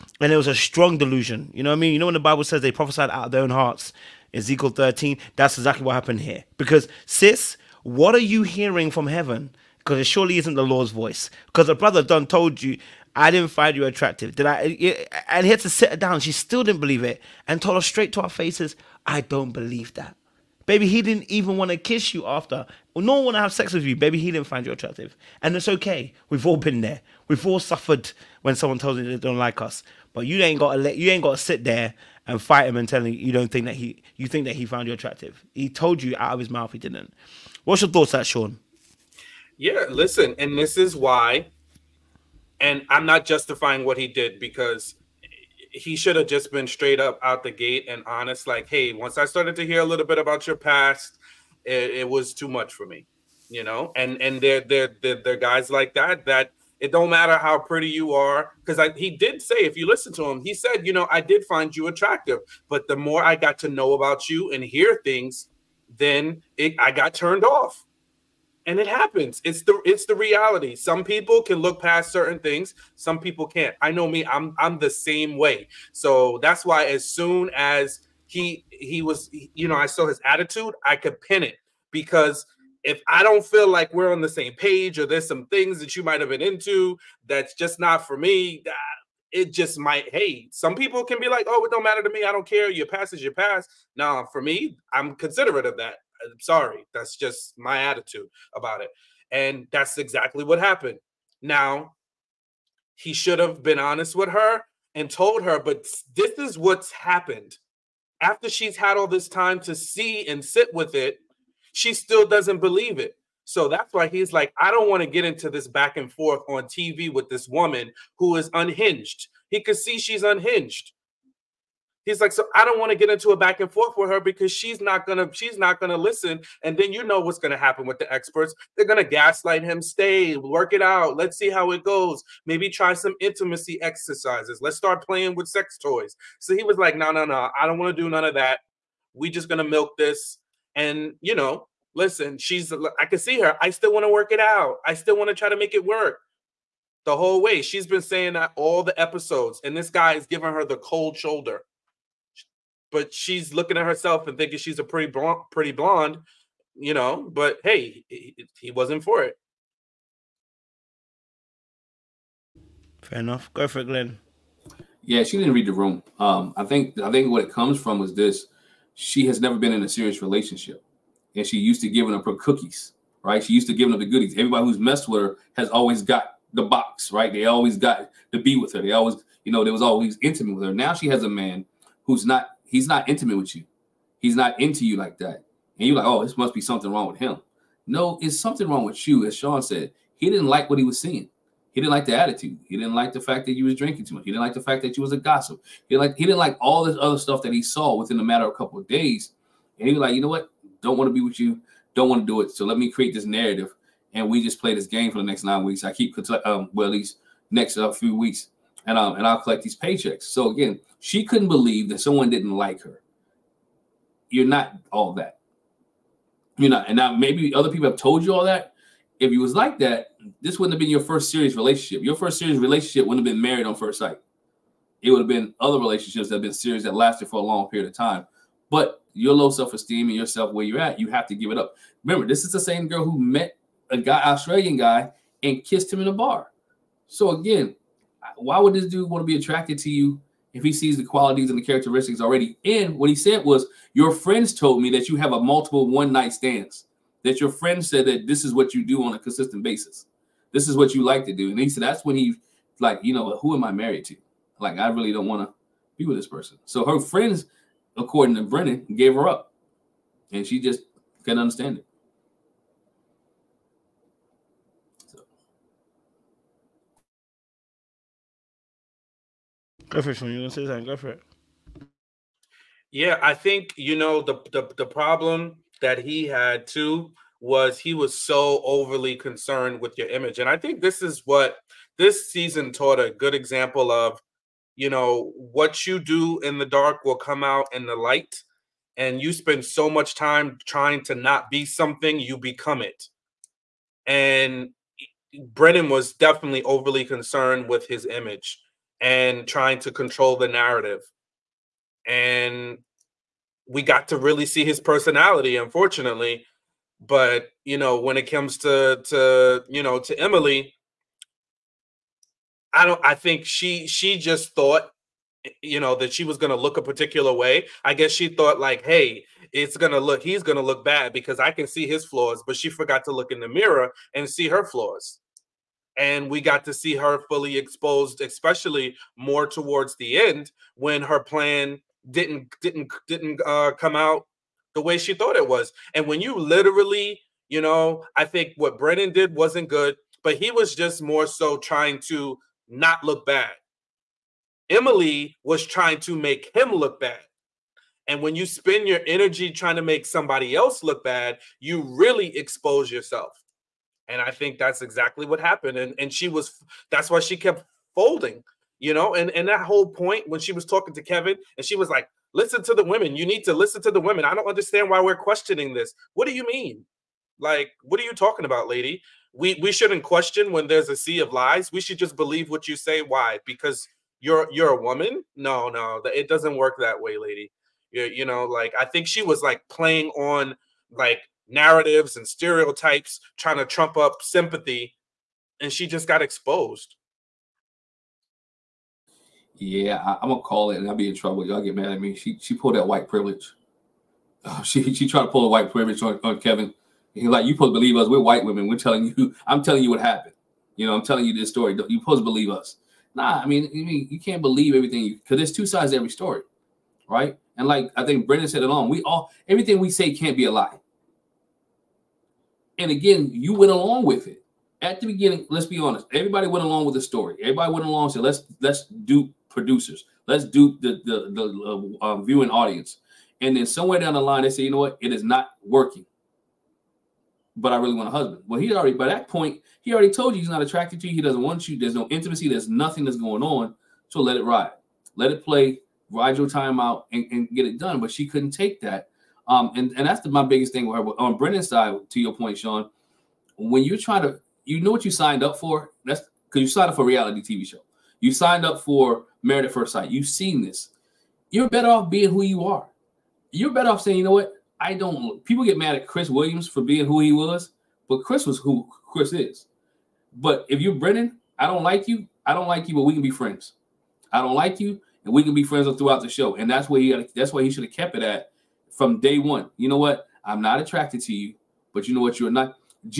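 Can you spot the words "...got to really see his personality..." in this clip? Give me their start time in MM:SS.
05:03.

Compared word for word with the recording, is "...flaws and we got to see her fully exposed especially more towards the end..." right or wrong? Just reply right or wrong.
right.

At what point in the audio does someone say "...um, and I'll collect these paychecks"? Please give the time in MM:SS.
03:28.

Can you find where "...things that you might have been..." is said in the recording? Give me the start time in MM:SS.
01:25.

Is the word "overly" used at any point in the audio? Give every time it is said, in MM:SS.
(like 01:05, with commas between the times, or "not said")
04:38, 04:56.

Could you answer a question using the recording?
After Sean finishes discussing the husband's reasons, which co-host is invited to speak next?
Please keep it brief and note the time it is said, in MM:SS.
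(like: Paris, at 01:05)
Glenn, at 02:43.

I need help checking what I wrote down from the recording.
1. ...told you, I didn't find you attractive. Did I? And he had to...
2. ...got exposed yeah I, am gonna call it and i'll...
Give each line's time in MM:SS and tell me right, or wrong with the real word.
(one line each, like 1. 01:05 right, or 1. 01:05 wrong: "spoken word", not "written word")
1. 00:12 right
2. 06:26 right.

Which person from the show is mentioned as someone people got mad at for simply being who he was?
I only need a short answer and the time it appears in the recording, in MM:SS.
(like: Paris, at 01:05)
Chris Williams, at 07:36.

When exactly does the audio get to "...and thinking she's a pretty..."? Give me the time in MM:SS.
02:34.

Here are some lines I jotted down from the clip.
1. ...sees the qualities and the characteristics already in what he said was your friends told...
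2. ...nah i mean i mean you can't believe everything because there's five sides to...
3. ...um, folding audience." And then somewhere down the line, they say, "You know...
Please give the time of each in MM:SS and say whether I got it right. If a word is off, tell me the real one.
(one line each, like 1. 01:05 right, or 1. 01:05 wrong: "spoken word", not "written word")
1. 04:00 right
2. 06:43 wrong: "two", not "five"
3. 07:02 wrong: "viewing", not "folding".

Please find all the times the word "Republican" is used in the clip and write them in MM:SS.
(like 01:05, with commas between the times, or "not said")
not said.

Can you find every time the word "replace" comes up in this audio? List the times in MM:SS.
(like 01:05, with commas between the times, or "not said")
not said.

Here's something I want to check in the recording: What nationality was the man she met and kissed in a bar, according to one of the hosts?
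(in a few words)
Australian.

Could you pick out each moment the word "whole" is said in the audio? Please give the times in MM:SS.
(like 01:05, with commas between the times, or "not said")
02:27, 05:59.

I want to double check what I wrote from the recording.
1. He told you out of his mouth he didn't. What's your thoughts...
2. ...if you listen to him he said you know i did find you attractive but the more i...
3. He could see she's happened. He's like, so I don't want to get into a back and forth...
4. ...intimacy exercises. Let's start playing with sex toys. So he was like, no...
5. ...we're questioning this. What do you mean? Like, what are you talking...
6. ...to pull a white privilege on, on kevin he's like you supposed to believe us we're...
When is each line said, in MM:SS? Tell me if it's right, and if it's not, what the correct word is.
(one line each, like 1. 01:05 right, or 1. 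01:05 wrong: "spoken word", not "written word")
1. 00:35 right
2. 00:59 right
3. 01:59 wrong: "unhinged", not "happened"
4. 02:13 right
5. 06:05 right
6. 06:35 right.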